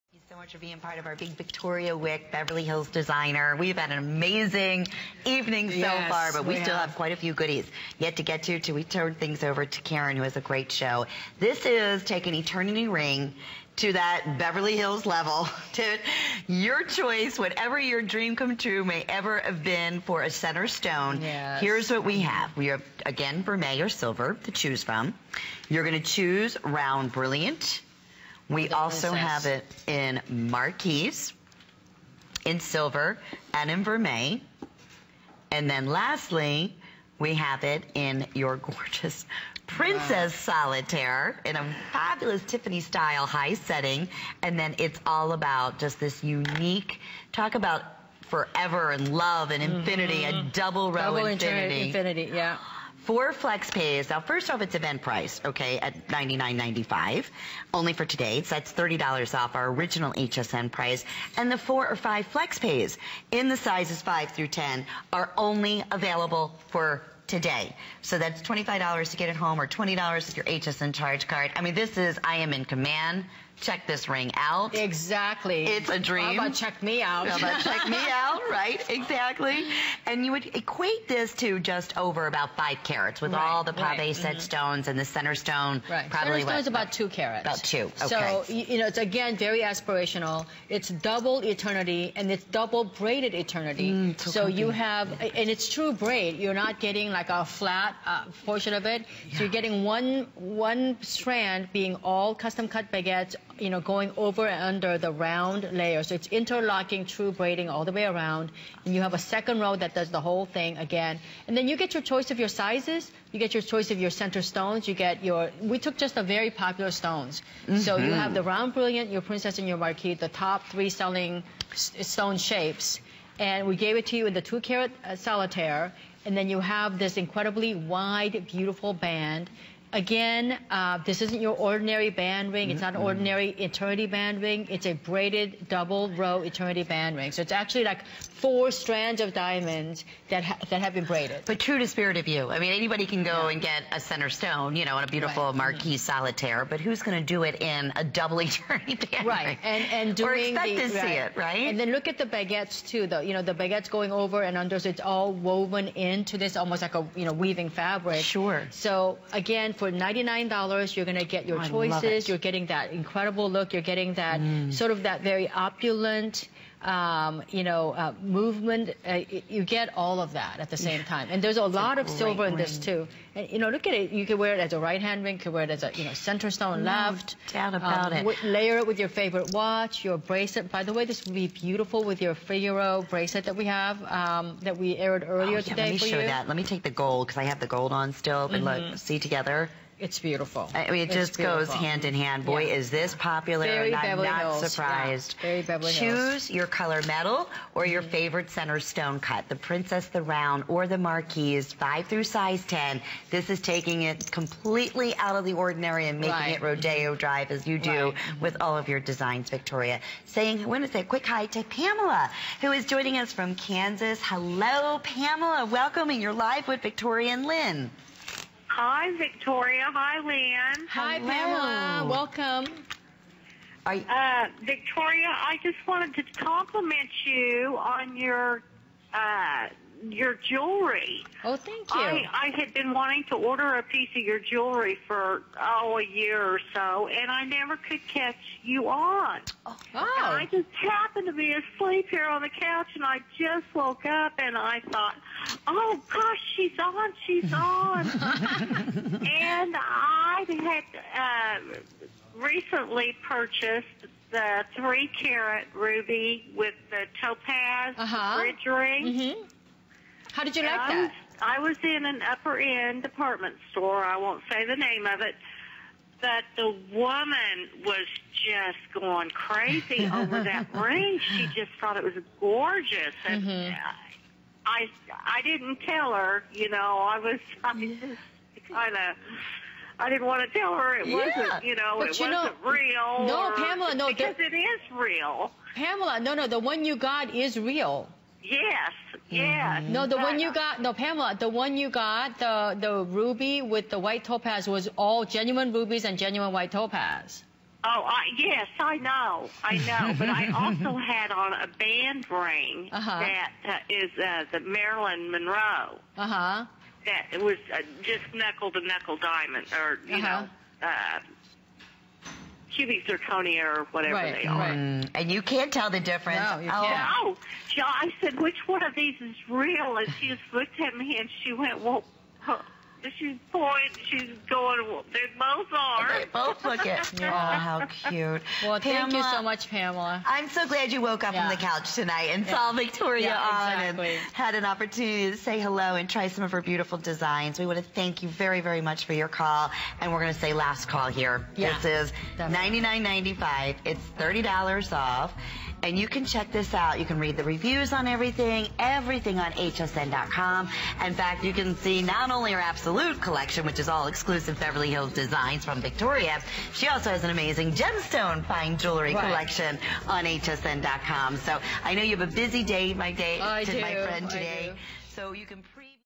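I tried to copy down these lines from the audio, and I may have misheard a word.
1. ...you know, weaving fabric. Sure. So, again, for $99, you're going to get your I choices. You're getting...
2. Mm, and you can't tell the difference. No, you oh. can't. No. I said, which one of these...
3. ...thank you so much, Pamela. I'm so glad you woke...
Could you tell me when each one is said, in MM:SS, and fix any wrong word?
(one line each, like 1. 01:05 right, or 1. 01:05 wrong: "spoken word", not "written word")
1. 02:37 right
2. 05:14 right
3. 05:28 right.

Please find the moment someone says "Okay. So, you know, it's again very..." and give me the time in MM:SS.
01:28.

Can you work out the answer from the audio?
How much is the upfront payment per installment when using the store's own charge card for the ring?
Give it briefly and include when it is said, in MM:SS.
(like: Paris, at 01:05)
$20, at 01:09.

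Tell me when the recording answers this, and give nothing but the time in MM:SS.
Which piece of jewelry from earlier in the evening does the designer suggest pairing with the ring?
03:02.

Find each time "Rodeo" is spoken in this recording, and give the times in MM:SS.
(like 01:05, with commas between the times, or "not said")
03:26.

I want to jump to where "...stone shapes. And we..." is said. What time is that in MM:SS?
02:02.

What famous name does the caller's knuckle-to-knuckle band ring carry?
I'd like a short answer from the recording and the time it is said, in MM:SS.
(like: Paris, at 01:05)
Marilyn Monroe, at 05:04.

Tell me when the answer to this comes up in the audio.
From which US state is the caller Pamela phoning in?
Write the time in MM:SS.
03:33.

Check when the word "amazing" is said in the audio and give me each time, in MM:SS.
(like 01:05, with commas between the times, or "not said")
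00:03, 05:57.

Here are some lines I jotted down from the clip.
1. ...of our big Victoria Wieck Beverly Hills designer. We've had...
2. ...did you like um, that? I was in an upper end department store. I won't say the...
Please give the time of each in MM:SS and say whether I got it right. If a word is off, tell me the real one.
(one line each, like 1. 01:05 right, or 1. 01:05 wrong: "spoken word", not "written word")
1. 00:00 right
2. 04:20 right.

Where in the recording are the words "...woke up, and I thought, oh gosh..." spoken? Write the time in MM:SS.
04:03.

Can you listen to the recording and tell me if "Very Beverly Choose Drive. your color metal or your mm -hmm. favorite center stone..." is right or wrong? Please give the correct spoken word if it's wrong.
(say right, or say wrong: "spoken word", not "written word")
wrong: "Hills", not "Drive".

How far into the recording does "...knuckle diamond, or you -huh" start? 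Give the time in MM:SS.
05:08.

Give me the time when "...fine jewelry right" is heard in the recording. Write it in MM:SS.
05:58.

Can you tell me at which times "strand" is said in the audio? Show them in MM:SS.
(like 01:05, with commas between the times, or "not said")
01:41, 02:18.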